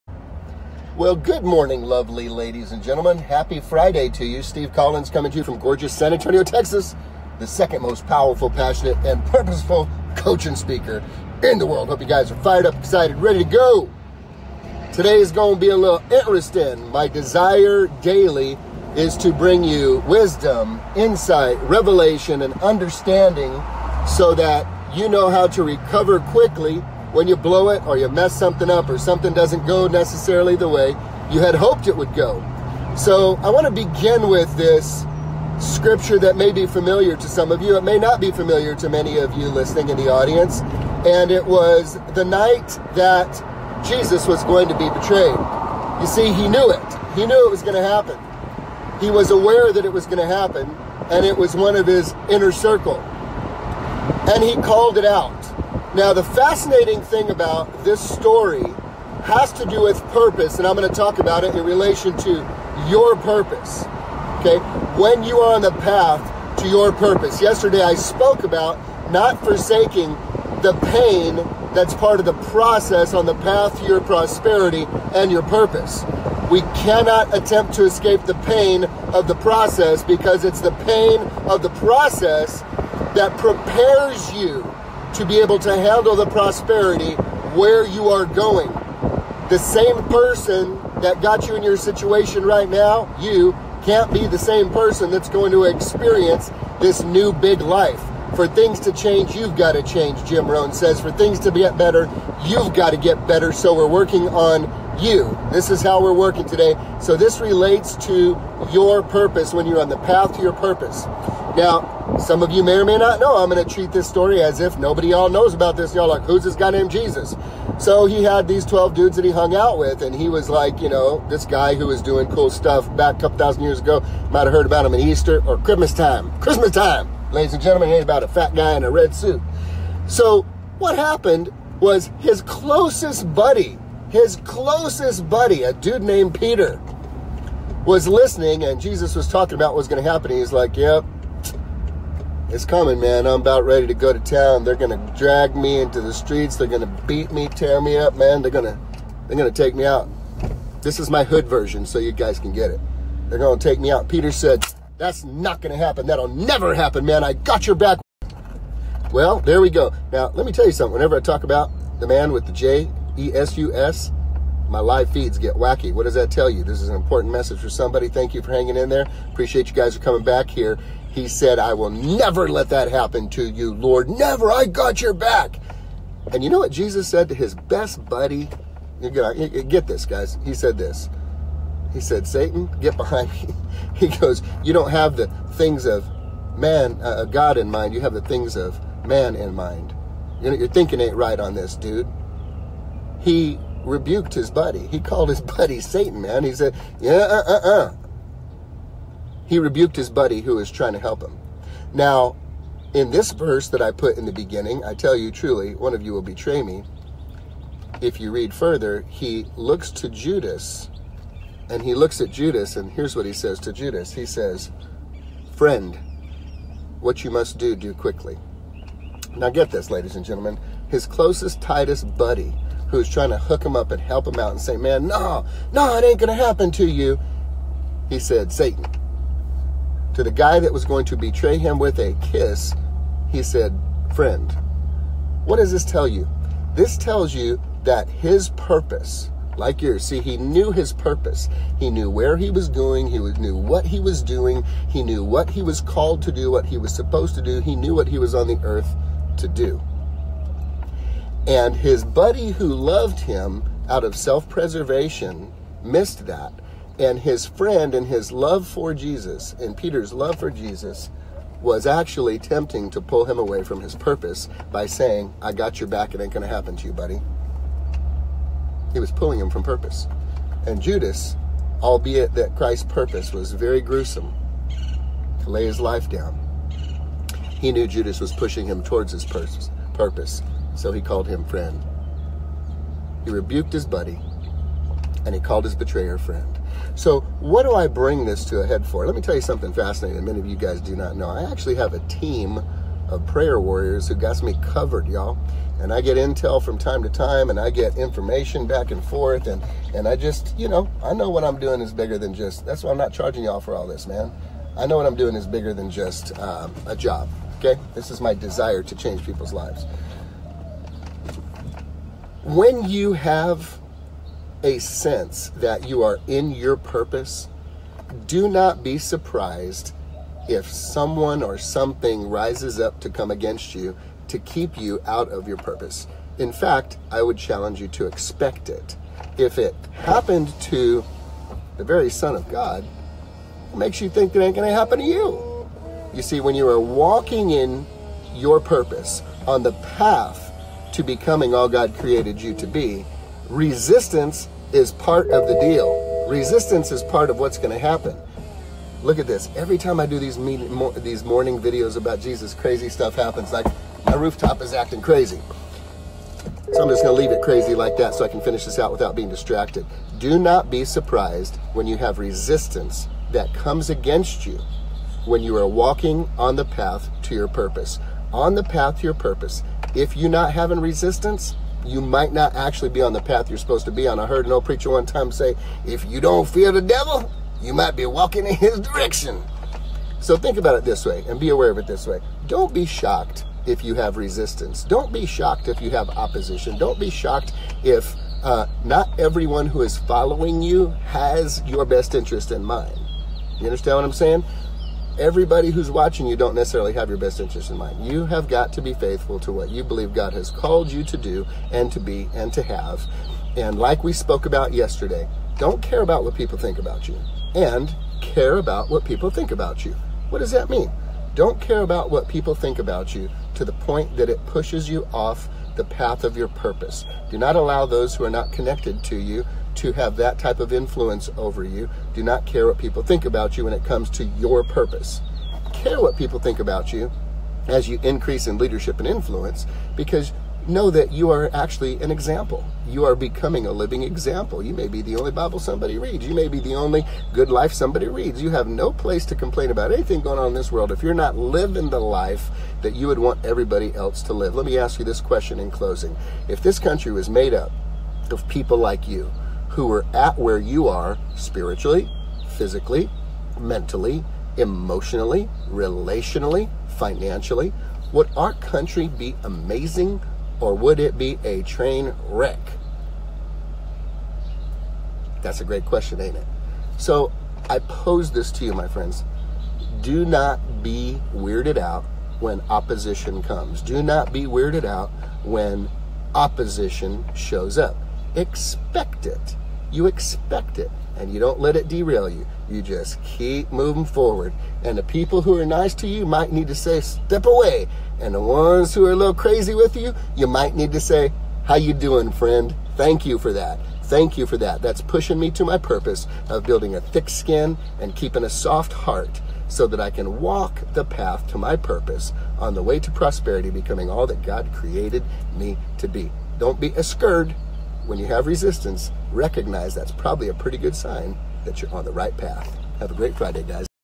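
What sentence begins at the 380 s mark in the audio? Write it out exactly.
So think about it this way and be aware of it this way.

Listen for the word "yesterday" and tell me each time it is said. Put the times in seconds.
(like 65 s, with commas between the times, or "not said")
67 s, 404 s.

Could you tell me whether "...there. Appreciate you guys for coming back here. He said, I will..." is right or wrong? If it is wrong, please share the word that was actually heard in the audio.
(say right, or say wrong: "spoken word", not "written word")
right.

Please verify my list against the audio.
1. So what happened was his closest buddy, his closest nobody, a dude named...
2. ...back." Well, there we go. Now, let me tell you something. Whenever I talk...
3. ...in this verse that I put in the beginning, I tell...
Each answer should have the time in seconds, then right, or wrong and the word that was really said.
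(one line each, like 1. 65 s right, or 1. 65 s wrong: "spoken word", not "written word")
1. 130 s wrong: "buddy", not "nobody"
2. 157 s right
3. 202 s right.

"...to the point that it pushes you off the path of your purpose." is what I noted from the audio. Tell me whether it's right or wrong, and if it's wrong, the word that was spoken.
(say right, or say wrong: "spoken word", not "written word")
right.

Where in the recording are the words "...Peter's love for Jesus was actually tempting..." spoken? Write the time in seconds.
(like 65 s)
259 s.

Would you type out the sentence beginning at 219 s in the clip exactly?
Now, get this, ladies and gentlemen.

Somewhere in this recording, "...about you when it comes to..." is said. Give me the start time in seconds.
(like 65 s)
423 s.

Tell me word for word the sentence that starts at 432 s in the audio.
You are becoming a living example.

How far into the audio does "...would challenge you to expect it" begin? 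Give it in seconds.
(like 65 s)
327 s.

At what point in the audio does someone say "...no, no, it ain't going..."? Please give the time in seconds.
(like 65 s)
225 s.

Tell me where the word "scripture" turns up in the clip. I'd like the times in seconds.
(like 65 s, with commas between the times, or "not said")
35 s.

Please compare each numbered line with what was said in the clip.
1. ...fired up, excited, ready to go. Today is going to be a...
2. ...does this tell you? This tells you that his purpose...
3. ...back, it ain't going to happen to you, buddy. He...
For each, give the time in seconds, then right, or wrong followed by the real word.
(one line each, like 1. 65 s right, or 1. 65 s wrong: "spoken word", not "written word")
1. 12 s right
2. 235 s right
3. 265 s right.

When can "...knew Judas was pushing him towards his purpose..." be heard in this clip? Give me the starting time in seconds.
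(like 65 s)
277 s.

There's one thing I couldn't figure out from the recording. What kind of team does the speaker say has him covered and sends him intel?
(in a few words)
prayer warriors.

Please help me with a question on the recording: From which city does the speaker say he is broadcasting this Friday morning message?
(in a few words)
San Antonio, Texas.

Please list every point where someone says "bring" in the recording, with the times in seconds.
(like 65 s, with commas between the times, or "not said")
19 s, 287 s.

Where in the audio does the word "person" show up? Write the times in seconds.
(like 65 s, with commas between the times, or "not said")
90 s, 94 s.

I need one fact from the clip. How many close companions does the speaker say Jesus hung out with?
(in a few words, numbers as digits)
12.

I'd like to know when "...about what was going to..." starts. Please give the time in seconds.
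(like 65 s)
139 s.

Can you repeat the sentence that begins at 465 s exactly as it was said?
That's a great question, ain't it?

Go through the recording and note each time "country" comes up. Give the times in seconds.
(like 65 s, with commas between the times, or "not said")
446 s, 458 s.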